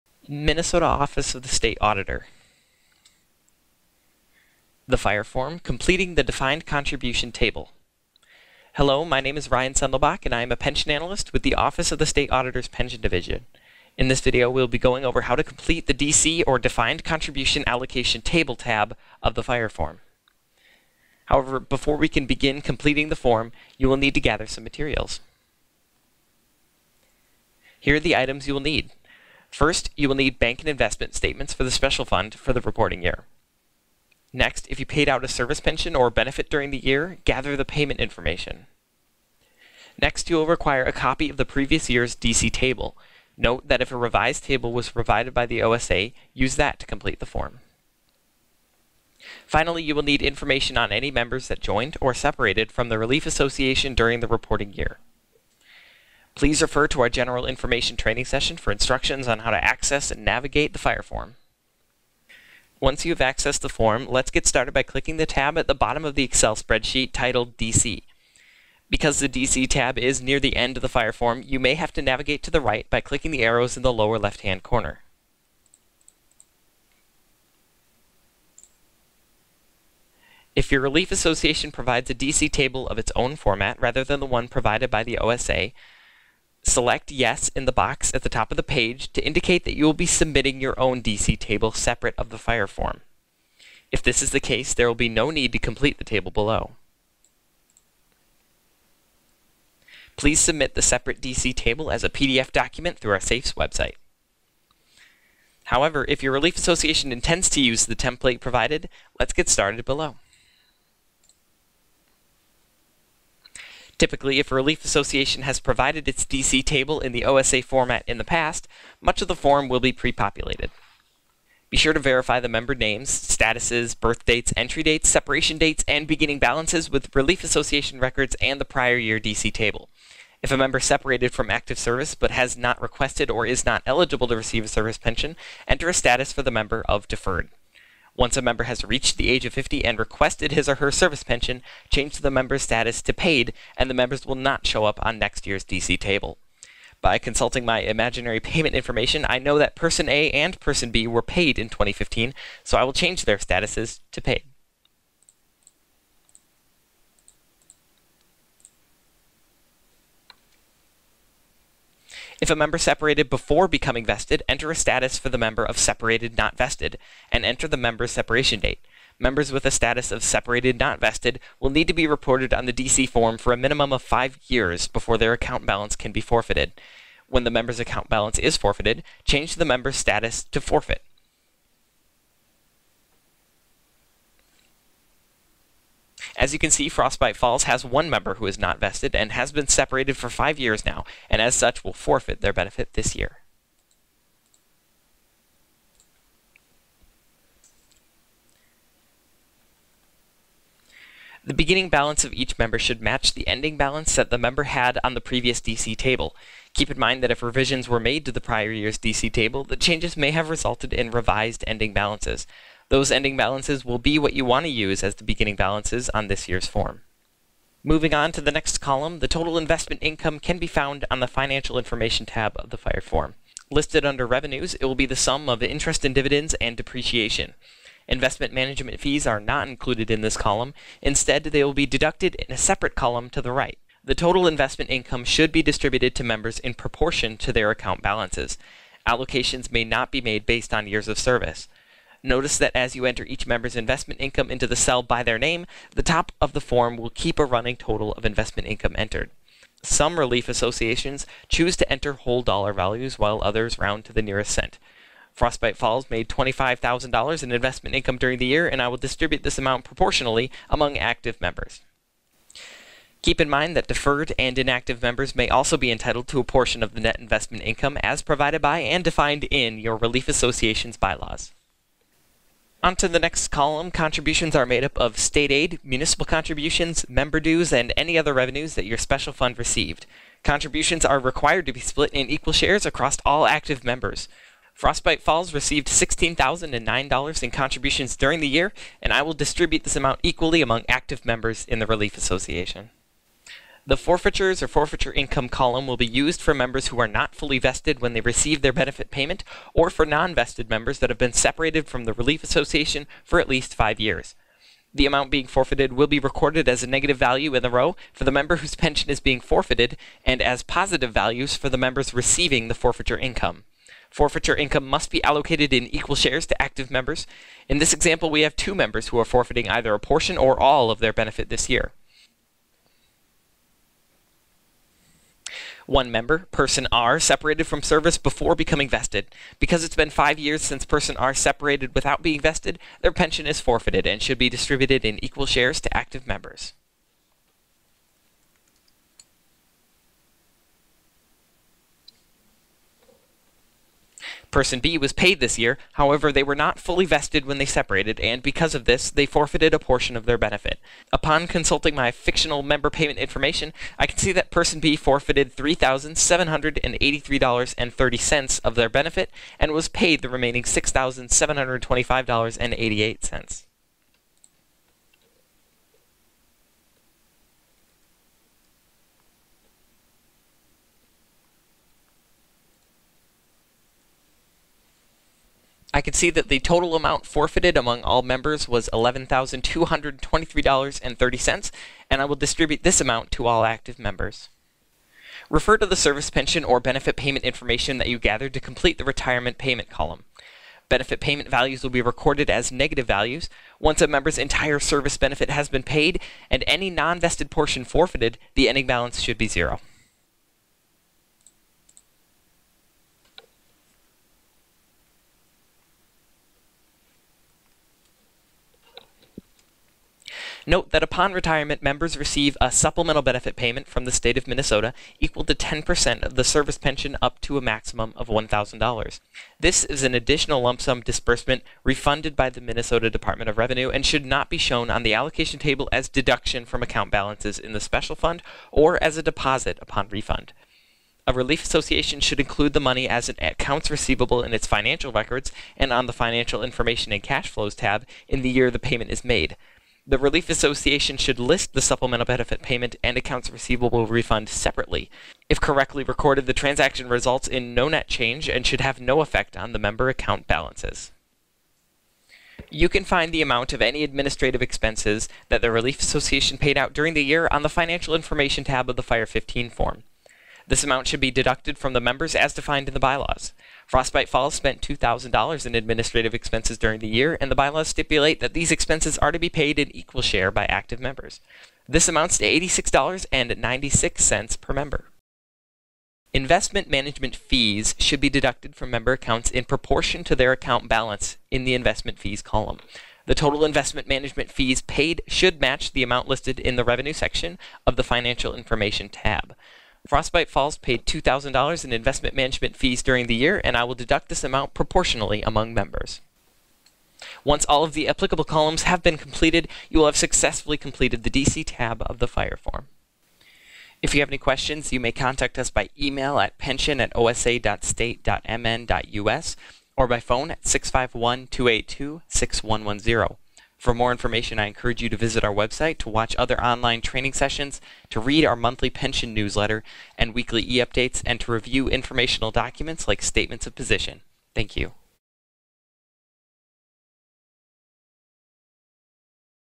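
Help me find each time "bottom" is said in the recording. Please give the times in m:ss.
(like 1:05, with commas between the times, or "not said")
1:05.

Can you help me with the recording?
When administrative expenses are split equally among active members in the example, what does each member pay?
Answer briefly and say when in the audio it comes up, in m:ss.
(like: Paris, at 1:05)
$86.96, at 7:52.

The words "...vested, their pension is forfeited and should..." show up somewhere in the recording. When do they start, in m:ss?
5:32.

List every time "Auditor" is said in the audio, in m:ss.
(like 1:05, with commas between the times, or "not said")
0:01, 0:12.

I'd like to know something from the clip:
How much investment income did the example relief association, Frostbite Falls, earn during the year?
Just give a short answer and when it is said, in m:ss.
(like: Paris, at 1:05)
$25,000, at 4:16.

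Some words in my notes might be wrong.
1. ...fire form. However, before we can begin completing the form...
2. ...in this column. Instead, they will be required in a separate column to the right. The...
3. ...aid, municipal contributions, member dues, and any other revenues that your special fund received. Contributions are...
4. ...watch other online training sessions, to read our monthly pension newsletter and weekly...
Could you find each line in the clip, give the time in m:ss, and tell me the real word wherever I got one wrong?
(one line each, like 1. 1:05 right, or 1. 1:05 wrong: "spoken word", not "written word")
1. 0:19 right
2. 3:50 wrong: "deducted", not "required"
3. 4:35 right
4. 8:36 right.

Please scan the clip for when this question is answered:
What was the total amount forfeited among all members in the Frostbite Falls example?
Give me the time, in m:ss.
6:18.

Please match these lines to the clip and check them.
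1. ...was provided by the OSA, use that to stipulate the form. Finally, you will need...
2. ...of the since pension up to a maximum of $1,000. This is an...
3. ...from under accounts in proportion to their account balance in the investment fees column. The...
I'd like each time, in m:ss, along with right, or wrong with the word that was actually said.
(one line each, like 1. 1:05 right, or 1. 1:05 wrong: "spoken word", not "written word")
1. 0:44 wrong: "complete", not "stipulate"
2. 6:56 wrong: "service", not "since"
3. 7:58 wrong: "member", not "under".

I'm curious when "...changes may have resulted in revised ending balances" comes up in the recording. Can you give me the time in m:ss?
3:29.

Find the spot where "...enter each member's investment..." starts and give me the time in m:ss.
4:03.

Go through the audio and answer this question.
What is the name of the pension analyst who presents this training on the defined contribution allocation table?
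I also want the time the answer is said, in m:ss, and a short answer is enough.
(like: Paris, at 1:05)
Ryan Sendelbach, at 0:09.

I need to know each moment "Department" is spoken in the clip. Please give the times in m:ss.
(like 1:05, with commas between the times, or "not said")
7:03.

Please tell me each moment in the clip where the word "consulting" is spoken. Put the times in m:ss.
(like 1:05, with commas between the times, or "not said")
2:27, 5:51.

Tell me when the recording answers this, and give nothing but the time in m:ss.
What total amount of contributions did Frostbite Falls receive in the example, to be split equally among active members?
4:45.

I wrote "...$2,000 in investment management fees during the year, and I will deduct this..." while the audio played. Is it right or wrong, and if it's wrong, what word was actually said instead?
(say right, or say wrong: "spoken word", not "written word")
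right.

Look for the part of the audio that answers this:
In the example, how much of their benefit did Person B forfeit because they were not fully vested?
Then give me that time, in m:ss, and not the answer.
5:55.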